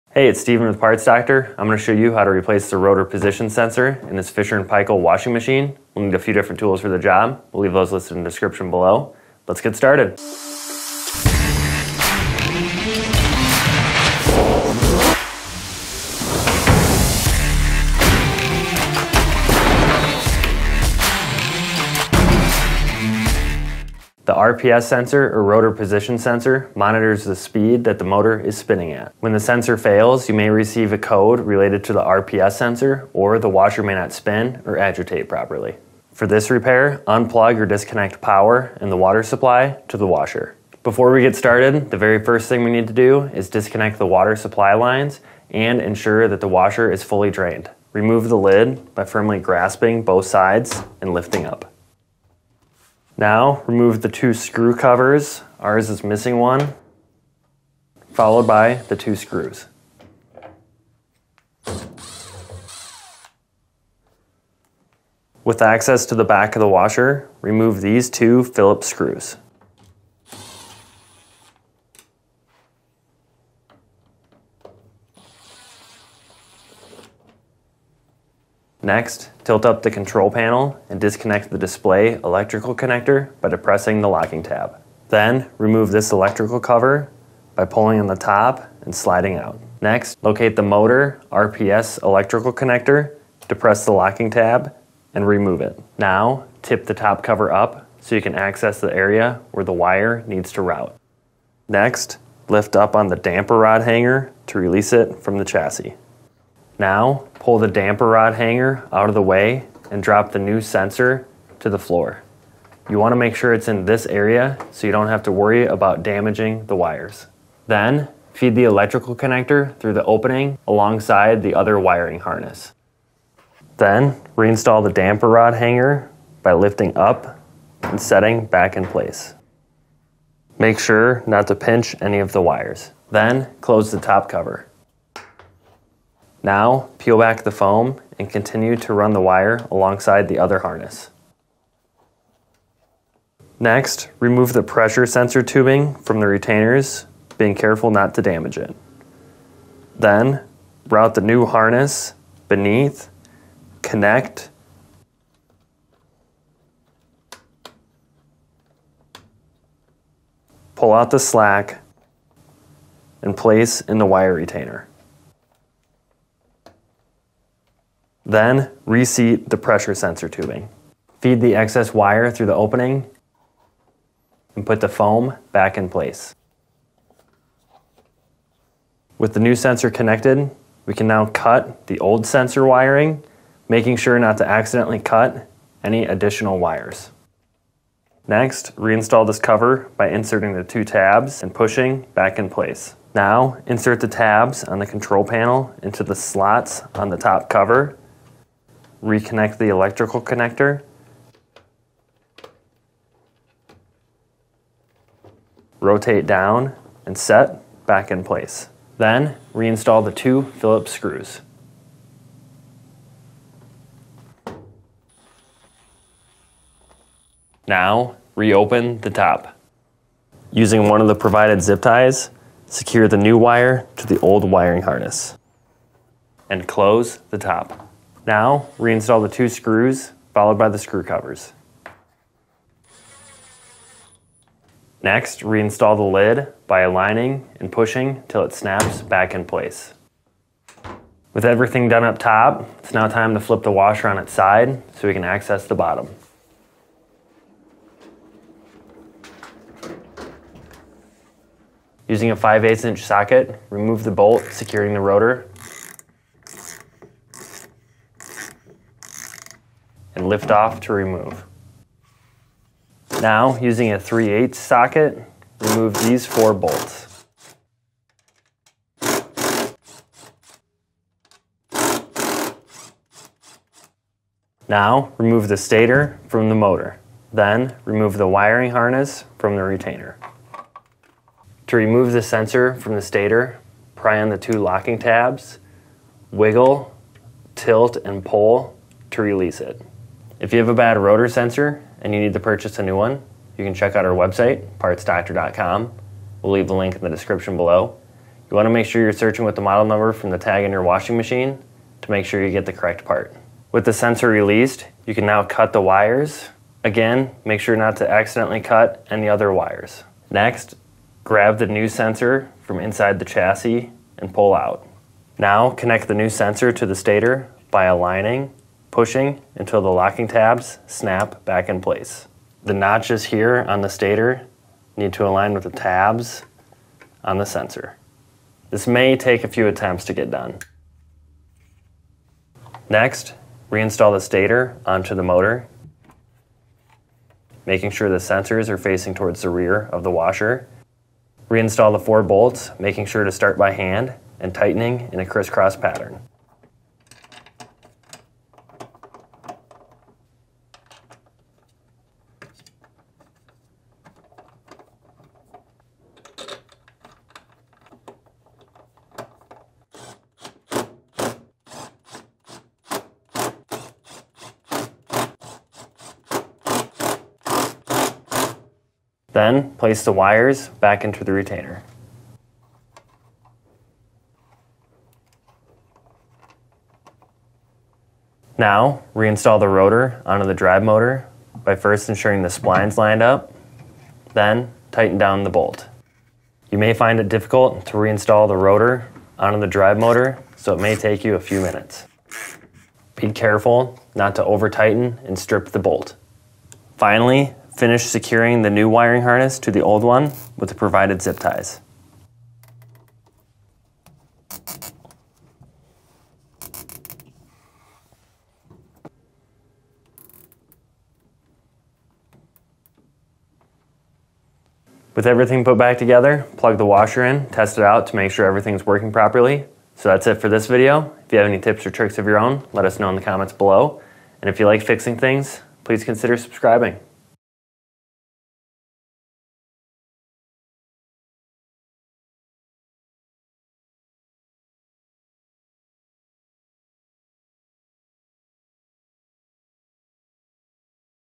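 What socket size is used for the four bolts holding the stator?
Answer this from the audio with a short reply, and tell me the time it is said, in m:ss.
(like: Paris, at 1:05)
3/8, at 4:23.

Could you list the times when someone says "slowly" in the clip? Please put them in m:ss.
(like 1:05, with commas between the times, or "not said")
not said.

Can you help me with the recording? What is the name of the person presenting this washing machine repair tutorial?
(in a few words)
Steven.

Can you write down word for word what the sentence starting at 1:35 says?
Now, tip the top cover up so you can access the area where the wire needs to route.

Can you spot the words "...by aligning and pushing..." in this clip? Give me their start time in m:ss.
3:56.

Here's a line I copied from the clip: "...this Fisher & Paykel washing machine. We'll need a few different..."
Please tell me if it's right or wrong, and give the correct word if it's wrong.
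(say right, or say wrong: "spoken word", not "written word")
right.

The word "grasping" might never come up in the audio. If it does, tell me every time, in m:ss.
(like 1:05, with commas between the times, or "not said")
0:49.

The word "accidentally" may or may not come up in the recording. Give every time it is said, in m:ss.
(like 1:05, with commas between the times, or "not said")
3:04, 5:08.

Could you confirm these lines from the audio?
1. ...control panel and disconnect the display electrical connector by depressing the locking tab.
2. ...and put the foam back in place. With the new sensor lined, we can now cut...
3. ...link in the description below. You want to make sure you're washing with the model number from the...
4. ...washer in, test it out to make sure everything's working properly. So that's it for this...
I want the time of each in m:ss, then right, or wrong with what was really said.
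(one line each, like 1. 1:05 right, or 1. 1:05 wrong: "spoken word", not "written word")
1. 1:19 right
2. 2:54 wrong: "connected", not "lined"
3. 4:56 wrong: "searching", not "washing"
4. 6:56 right.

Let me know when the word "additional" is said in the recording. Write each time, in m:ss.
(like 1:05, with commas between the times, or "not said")
3:06.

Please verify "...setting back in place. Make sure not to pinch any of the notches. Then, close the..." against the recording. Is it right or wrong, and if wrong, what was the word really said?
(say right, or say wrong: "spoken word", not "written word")
wrong: "wires", not "notches".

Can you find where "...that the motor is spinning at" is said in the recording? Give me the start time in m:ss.
0:27.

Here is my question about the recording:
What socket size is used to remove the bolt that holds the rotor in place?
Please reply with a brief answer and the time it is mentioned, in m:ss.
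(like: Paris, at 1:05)
5/8 inch, at 4:12.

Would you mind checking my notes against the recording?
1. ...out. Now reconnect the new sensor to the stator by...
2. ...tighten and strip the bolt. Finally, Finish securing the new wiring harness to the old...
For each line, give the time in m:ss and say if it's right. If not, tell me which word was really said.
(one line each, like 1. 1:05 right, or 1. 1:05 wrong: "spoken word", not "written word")
1. 5:14 wrong: "connect", not "reconnect"
2. 6:34 right.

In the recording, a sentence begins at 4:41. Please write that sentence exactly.
To remove the sensor from the stator, pry on the two locking tabs, wiggle, tilt, and pull to release it.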